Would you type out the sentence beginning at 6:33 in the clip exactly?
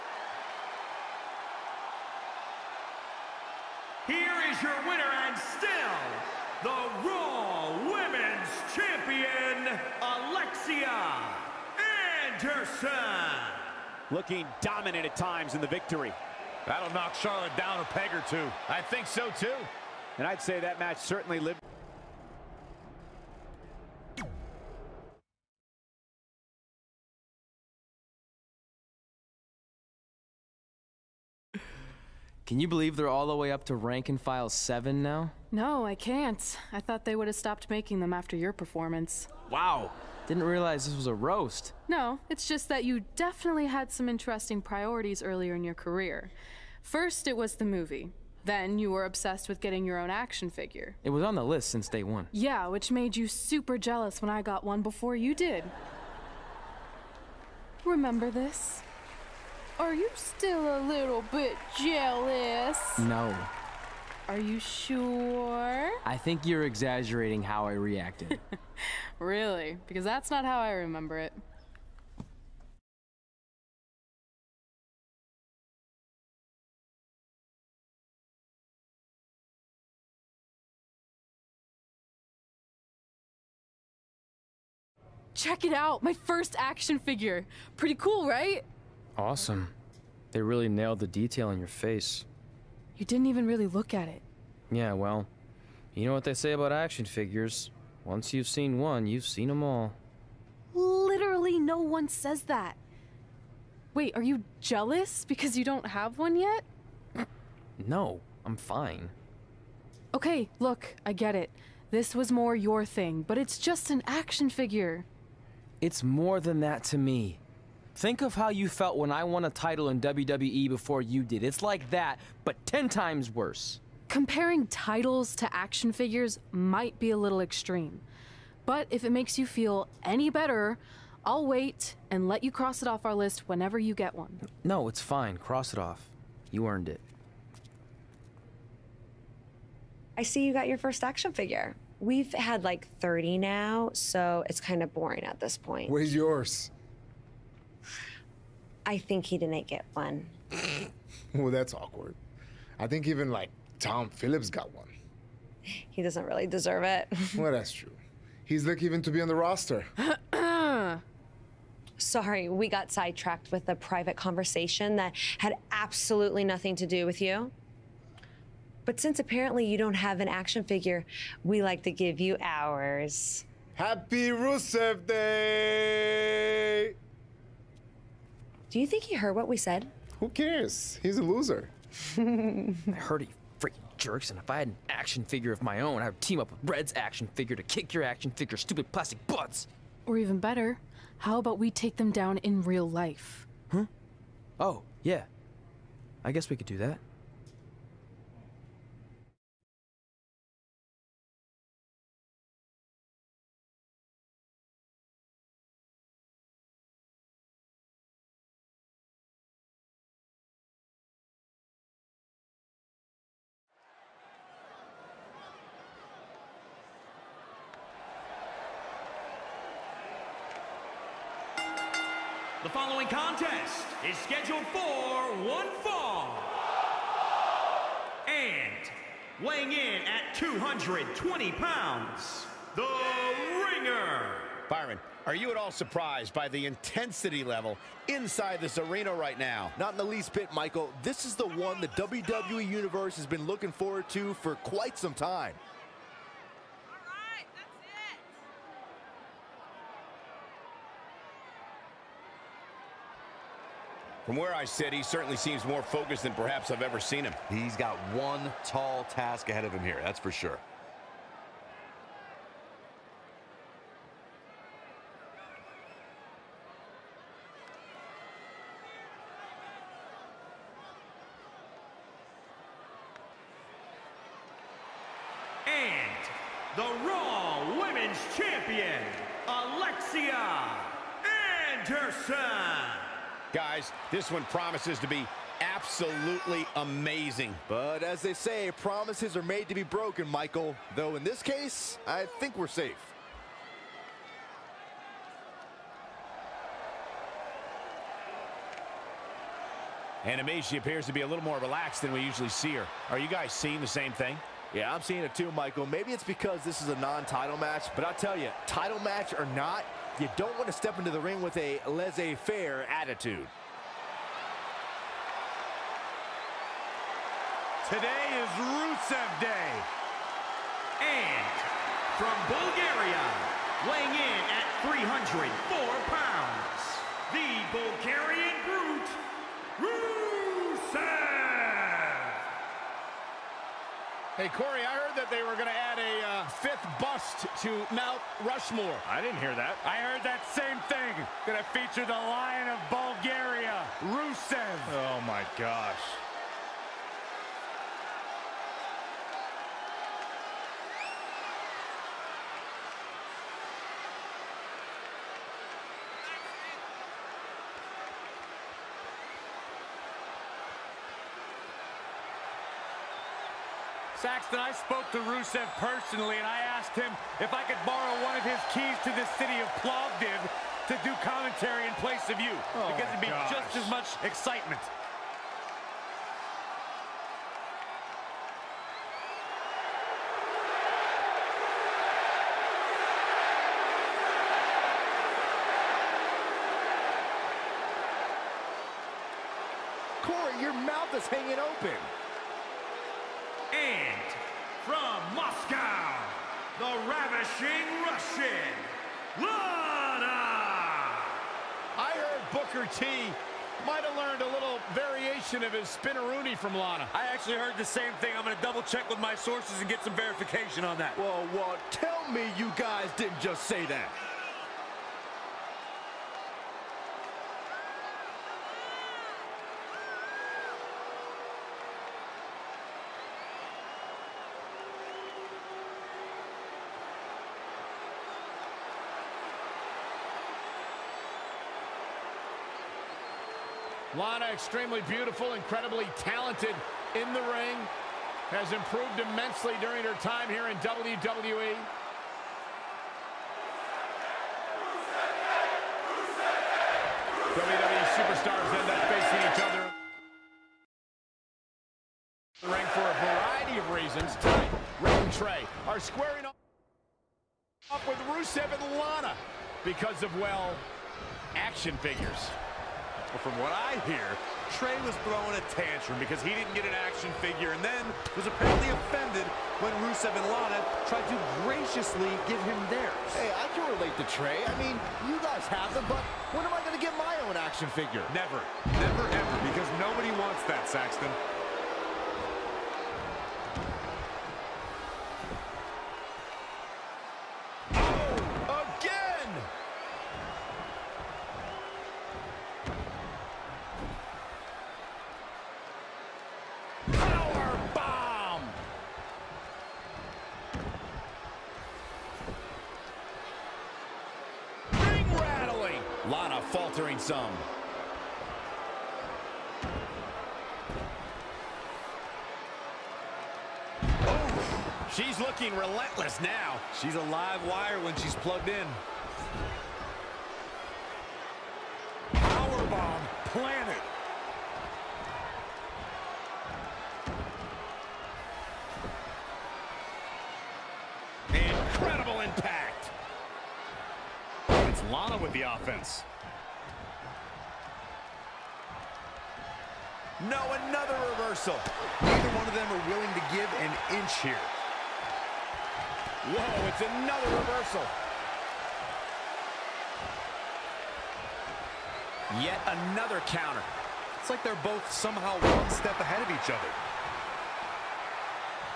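And from Moscow, the ravishing Russian, Lana!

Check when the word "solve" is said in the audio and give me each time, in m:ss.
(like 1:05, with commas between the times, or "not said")
not said.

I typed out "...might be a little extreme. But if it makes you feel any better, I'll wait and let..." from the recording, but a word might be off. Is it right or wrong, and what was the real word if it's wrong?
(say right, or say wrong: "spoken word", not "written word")
right.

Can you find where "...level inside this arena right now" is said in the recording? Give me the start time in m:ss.
3:57.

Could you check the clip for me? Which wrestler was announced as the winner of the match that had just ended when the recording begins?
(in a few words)
Garcia Anderson.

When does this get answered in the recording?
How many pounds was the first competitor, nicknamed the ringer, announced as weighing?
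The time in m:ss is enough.
3:50.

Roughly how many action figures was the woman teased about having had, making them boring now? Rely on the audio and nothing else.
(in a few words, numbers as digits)
30.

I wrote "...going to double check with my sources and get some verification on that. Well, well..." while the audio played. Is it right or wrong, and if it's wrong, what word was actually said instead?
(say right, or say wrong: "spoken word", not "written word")
right.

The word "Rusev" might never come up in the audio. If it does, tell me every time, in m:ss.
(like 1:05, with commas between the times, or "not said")
2:54, 5:18, 5:29, 5:44, 6:05, 7:38, 7:50.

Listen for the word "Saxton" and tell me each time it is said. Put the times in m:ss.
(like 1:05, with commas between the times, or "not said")
6:04, 8:00.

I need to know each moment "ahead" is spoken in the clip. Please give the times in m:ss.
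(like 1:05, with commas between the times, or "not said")
4:19, 9:16.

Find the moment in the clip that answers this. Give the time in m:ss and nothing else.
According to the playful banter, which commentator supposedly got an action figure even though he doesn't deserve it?
2:33.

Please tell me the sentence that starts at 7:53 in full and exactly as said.
Hey, I can relate to Trey.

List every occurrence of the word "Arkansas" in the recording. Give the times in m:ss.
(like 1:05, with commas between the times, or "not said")
not said.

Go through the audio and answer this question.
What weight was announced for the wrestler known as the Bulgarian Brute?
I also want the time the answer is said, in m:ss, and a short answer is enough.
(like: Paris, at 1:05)
304 pounds, at 5:25.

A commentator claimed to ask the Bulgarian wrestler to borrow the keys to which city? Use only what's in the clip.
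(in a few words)
Plovdiv.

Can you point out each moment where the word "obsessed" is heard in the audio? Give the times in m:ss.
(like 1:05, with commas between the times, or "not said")
0:49.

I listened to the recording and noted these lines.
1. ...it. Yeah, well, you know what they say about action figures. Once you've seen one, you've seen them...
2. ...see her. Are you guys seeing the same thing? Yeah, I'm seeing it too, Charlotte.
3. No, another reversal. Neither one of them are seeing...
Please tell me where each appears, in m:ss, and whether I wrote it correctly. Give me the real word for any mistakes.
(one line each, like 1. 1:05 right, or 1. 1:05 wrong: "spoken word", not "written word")
1. 1:34 right
2. 5:02 wrong: "Michael", not "Charlotte"
3. 9:00 wrong: "willing", not "seeing".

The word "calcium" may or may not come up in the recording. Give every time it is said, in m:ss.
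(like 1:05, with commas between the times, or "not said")
not said.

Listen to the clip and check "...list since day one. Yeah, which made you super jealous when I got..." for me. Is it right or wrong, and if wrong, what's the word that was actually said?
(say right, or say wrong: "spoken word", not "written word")
right.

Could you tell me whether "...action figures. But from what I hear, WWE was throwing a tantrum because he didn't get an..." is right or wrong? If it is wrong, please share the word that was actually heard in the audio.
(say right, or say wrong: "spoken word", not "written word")
wrong: "Trey", not "WWE".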